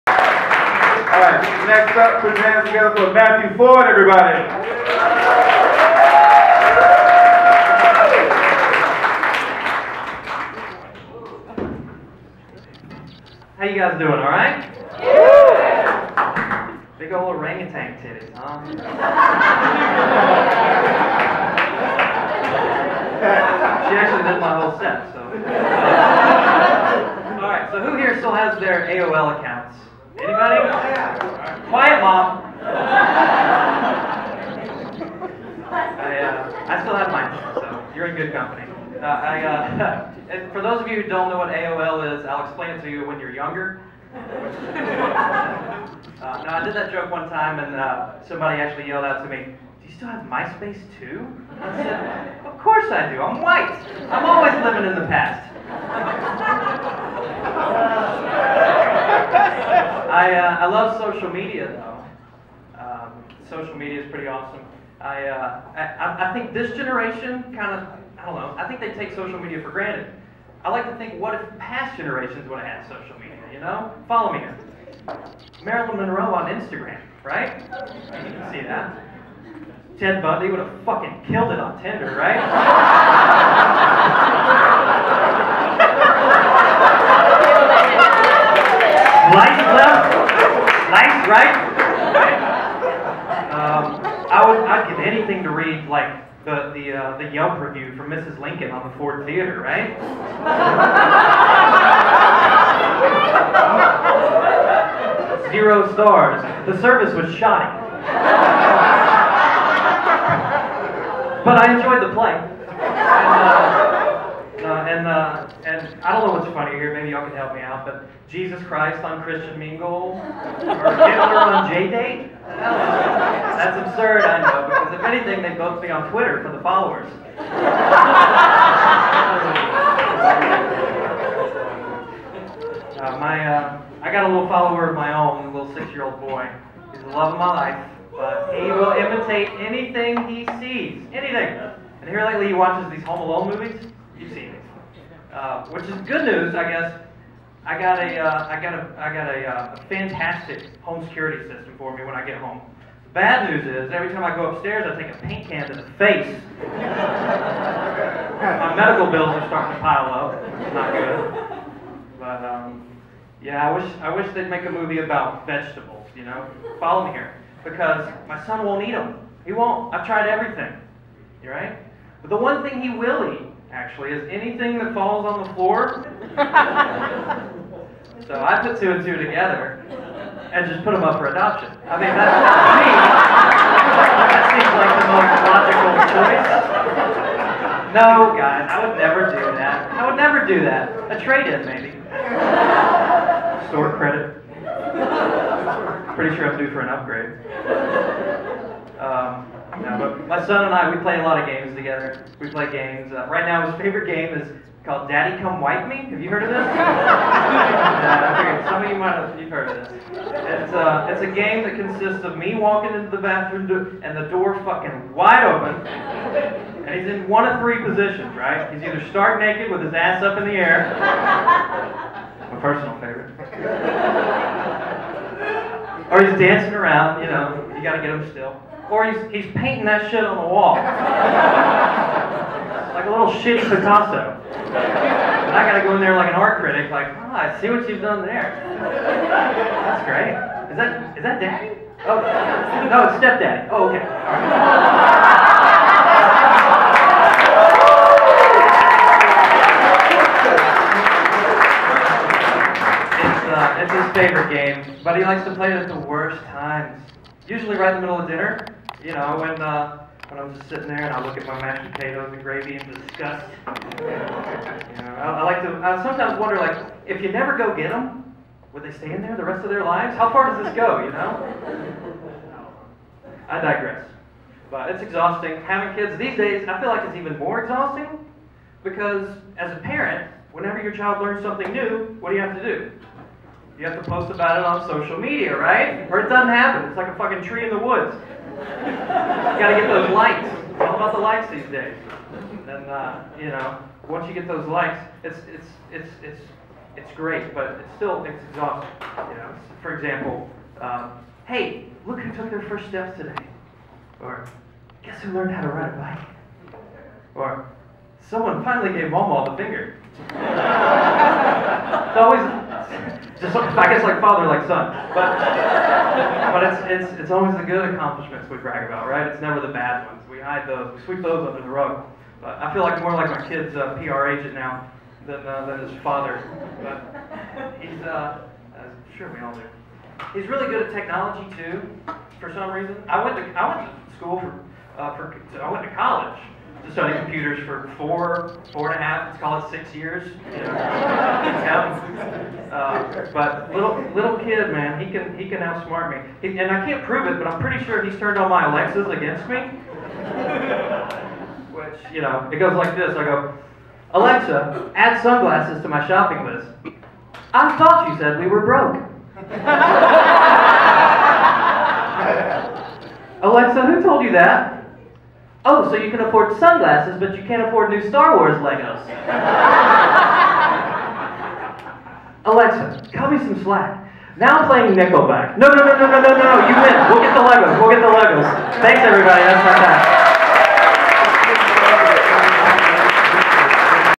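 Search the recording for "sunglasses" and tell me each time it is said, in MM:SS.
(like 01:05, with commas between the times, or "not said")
05:55, 06:06.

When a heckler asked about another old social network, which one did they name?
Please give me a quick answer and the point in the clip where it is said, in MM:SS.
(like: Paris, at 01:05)
MySpace, at 00:50.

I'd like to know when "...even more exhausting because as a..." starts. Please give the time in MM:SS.
04:37.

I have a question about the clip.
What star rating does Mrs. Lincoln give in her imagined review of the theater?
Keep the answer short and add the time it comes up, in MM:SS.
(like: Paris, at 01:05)
0 stars, at 01:45.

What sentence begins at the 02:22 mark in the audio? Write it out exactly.
And here lately, he watches these Home Alone movies.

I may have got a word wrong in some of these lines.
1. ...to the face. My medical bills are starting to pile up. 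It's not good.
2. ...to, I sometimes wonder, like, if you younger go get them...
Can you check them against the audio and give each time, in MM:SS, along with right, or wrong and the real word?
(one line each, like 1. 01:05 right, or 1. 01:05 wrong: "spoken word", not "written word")
1. 02:35 right
2. 04:25 wrong: "never", not "younger".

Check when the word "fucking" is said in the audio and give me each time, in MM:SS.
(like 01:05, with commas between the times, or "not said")
01:20, 03:34, 04:47.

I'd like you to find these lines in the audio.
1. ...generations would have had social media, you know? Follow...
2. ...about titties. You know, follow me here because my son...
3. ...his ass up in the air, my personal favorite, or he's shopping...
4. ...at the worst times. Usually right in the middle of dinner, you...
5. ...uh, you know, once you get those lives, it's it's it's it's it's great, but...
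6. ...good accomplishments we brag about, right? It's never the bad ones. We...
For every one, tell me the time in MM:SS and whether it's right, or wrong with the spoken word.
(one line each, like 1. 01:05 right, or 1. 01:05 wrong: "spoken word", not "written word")
1. 01:11 right
2. 02:44 wrong: "vegetables", not "titties"
3. 03:39 wrong: "dancing", not "shopping"
4. 04:15 right
5. 04:52 wrong: "likes", not "lives"
6. 05:17 right.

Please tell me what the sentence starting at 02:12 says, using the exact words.
uh, my, uh, I got a little follower of my own, a little six-year-old boy.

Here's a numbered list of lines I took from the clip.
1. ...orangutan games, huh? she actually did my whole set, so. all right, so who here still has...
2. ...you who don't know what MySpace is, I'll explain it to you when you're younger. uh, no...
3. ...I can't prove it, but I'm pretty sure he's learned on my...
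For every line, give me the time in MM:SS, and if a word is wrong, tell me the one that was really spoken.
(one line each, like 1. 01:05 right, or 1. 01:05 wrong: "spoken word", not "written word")
1. 00:17 wrong: "titties", not "games"
2. 00:40 wrong: "AOL", not "MySpace"
3. 05:46 wrong: "turned", not "learned".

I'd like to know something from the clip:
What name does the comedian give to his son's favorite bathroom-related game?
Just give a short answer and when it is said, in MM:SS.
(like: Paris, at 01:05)
Daddy Come Wipe Me, at 03:25.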